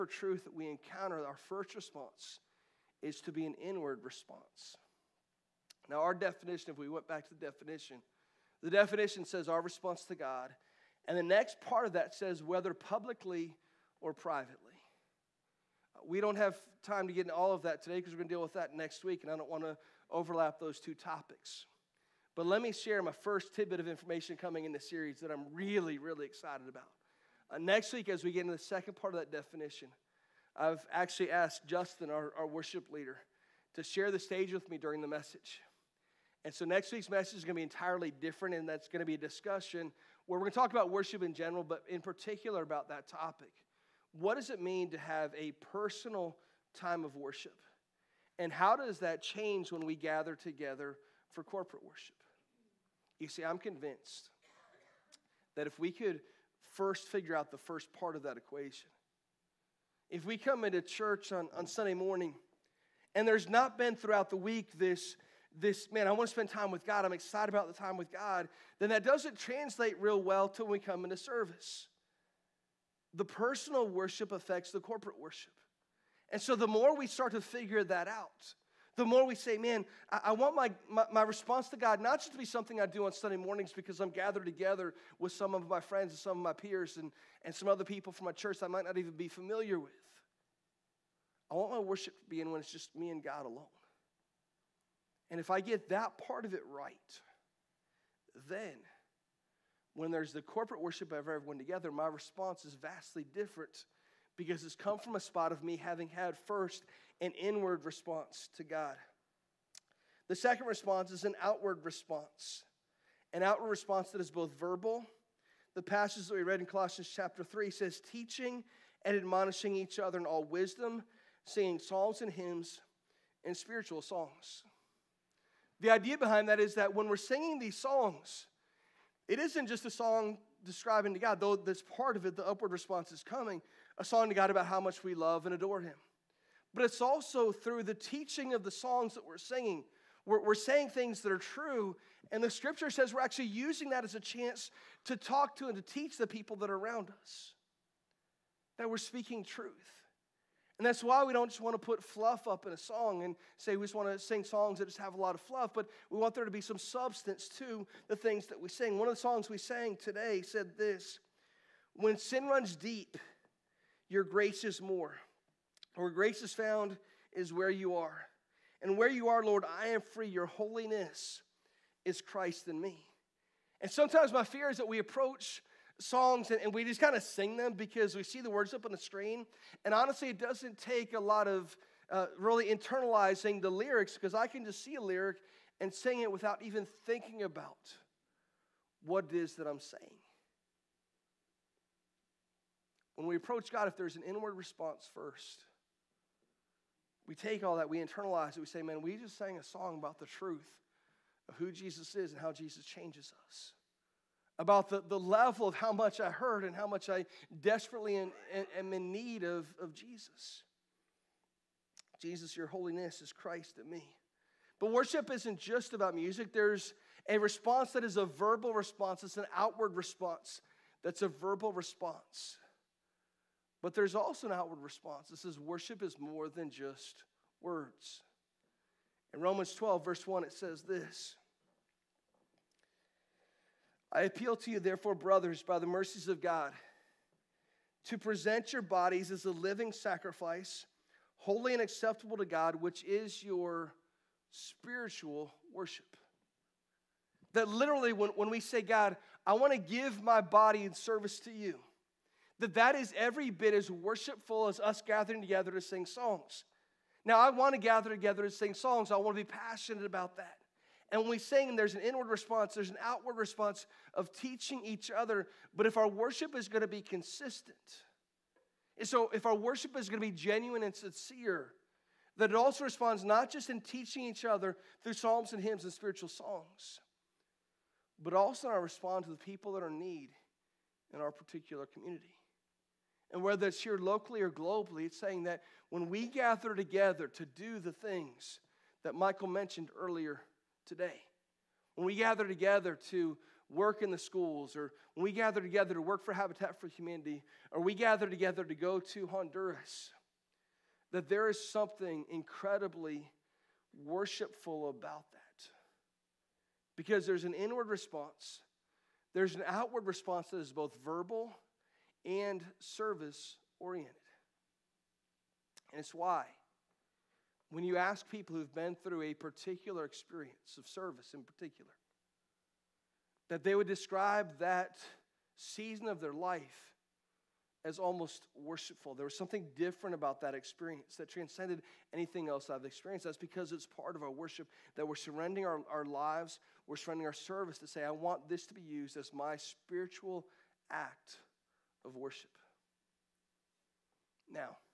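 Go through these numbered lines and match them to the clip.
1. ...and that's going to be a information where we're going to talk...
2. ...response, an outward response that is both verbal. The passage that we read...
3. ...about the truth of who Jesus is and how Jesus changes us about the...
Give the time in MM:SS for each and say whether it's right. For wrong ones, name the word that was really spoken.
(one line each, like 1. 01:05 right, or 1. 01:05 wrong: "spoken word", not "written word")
1. 00:38 wrong: "discussion", not "information"
2. 01:51 right
3. 03:19 right.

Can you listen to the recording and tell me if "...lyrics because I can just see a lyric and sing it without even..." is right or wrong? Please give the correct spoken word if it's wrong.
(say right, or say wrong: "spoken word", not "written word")
right.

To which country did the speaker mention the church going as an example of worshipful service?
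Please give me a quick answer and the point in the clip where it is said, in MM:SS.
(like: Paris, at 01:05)
Honduras, at 04:59.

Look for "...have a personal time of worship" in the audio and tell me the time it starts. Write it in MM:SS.
00:44.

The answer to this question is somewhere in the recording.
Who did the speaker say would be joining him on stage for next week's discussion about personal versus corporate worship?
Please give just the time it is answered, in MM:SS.
00:31.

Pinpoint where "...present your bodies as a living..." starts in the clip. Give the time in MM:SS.
03:58.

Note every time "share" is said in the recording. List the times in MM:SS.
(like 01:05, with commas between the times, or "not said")
00:22, 00:33.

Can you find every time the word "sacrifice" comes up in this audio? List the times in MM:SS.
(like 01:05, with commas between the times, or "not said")
03:59.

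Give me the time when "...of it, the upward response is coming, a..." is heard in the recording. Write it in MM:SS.
02:12.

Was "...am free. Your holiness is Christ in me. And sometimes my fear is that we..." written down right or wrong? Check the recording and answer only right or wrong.
right.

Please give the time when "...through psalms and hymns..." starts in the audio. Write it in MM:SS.
04:35.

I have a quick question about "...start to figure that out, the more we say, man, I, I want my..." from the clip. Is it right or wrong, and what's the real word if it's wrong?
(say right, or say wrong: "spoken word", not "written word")
right.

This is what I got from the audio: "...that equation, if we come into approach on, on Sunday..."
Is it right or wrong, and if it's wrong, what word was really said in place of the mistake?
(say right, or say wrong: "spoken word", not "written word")
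wrong: "church", not "approach".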